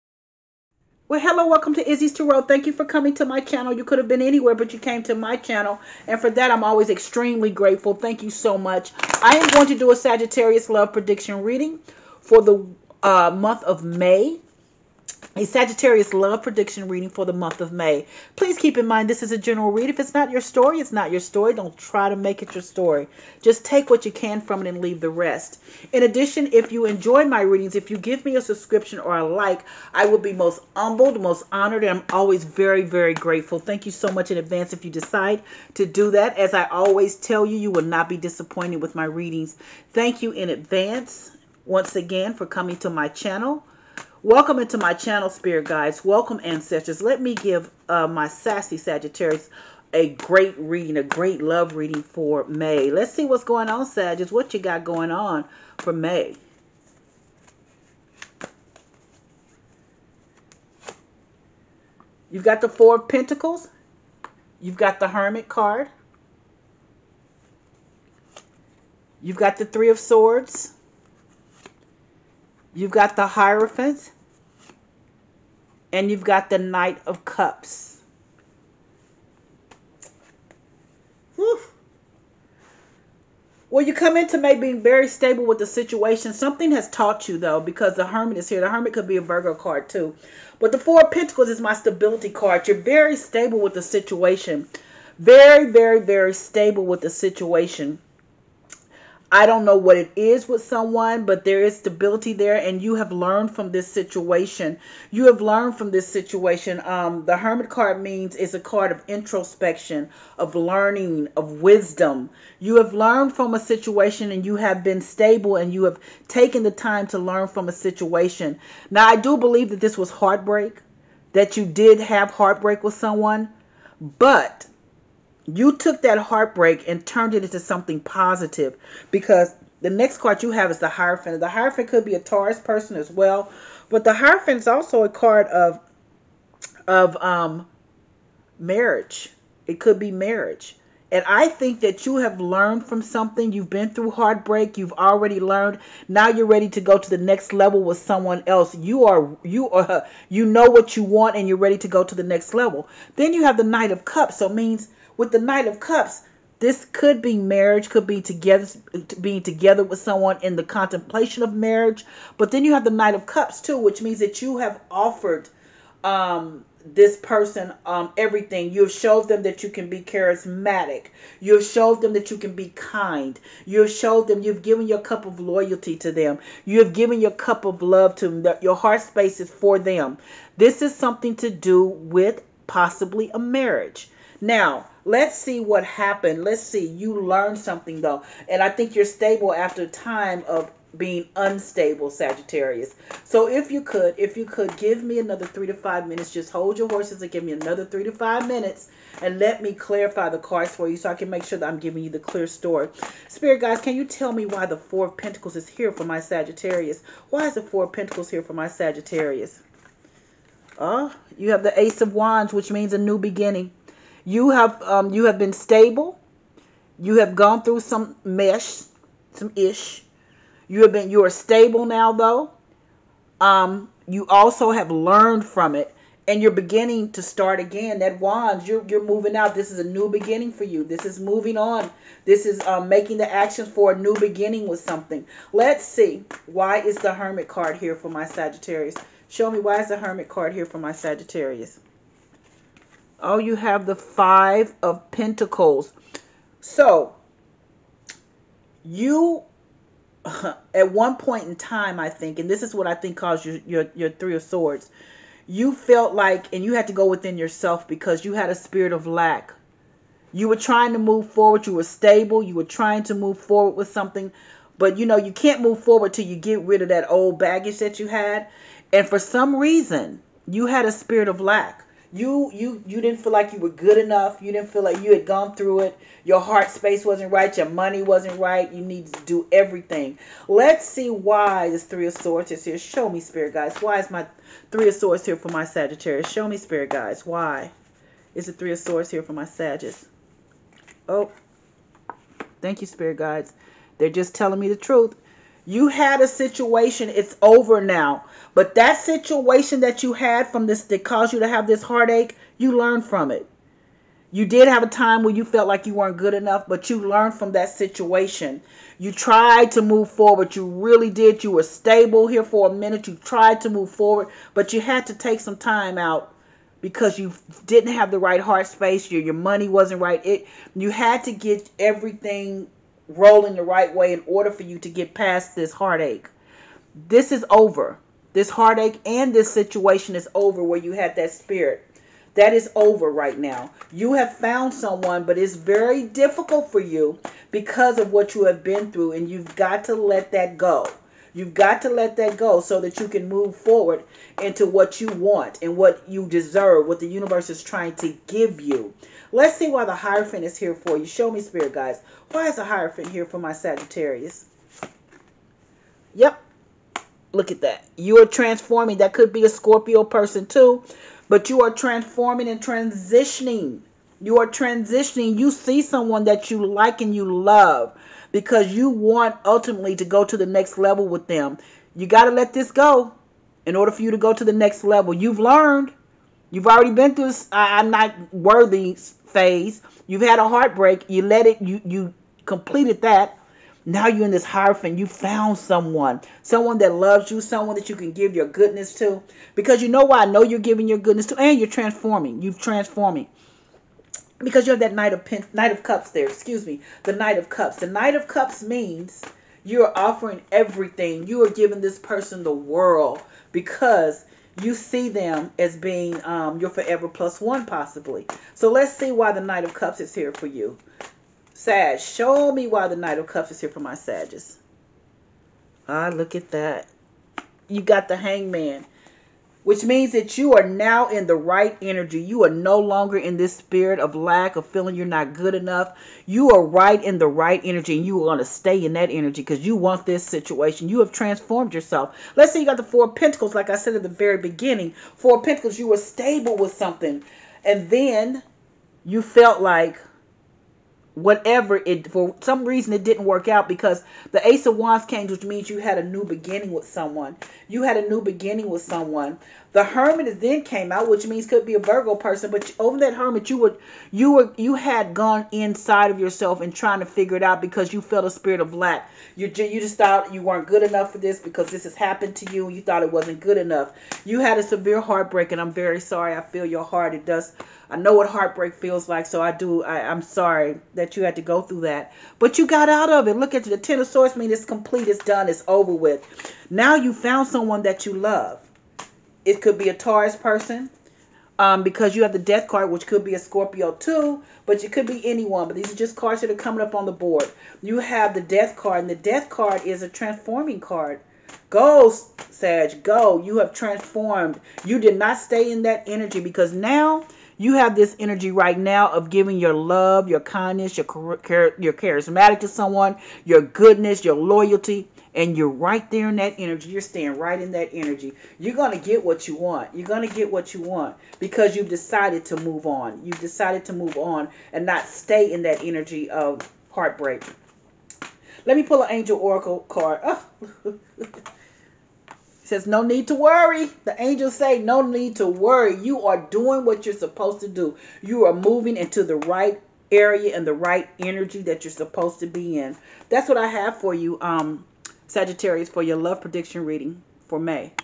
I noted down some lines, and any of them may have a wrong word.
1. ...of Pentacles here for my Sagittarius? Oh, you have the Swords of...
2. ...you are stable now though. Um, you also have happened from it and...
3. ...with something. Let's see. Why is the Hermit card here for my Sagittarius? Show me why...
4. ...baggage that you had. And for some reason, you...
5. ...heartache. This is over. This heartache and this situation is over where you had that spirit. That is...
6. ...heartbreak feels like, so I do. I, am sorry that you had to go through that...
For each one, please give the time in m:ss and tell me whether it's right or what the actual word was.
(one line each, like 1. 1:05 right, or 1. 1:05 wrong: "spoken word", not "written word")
1. 3:27 wrong: "Ace", not "Swords"
2. 3:41 wrong: "learned", not "happened"
3. 3:54 right
4. 4:27 right
5. 5:25 right
6. 7:48 right.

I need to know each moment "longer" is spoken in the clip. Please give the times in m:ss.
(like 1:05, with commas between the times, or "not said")
7:02.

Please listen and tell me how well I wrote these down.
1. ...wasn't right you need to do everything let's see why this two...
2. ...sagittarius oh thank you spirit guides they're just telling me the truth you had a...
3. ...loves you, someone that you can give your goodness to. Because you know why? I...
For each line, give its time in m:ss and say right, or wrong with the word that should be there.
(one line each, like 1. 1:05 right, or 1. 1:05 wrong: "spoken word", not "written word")
1. 4:38 wrong: "three", not "two"
2. 4:49 right
3. 6:26 right.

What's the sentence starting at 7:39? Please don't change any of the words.
You you just thought you weren't good enough for this because this has happened to you.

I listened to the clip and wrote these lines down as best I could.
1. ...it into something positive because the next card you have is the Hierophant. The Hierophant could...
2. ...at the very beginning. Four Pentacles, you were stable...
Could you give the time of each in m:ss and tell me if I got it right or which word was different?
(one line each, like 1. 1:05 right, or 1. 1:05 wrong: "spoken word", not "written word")
1. 2:07 right
2. 7:13 right.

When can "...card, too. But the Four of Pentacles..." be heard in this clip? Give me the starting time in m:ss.
1:29.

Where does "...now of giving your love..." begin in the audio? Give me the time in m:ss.
8:18.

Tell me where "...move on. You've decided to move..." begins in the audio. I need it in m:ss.
8:32.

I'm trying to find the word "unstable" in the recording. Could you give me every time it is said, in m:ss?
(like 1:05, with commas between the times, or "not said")
3:11.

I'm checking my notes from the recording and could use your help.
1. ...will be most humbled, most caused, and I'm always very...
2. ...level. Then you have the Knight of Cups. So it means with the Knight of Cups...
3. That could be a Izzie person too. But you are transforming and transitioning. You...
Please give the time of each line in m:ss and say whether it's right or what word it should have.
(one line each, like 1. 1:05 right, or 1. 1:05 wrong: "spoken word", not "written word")
1. 0:30 wrong: "honored", not "caused"
2. 2:32 right
3. 5:58 wrong: "Scorpio", not "Izzie".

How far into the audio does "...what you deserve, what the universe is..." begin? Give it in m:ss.
5:45.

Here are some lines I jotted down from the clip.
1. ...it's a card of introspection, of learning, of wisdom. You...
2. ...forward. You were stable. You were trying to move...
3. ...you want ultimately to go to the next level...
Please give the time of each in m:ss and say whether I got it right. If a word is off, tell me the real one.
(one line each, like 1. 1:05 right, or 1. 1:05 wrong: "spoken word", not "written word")
1. 1:48 right
2. 4:21 right
3. 6:08 right.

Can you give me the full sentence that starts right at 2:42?
But then you have the Knight of Cups too, which means that you have offered um, this person um, everything.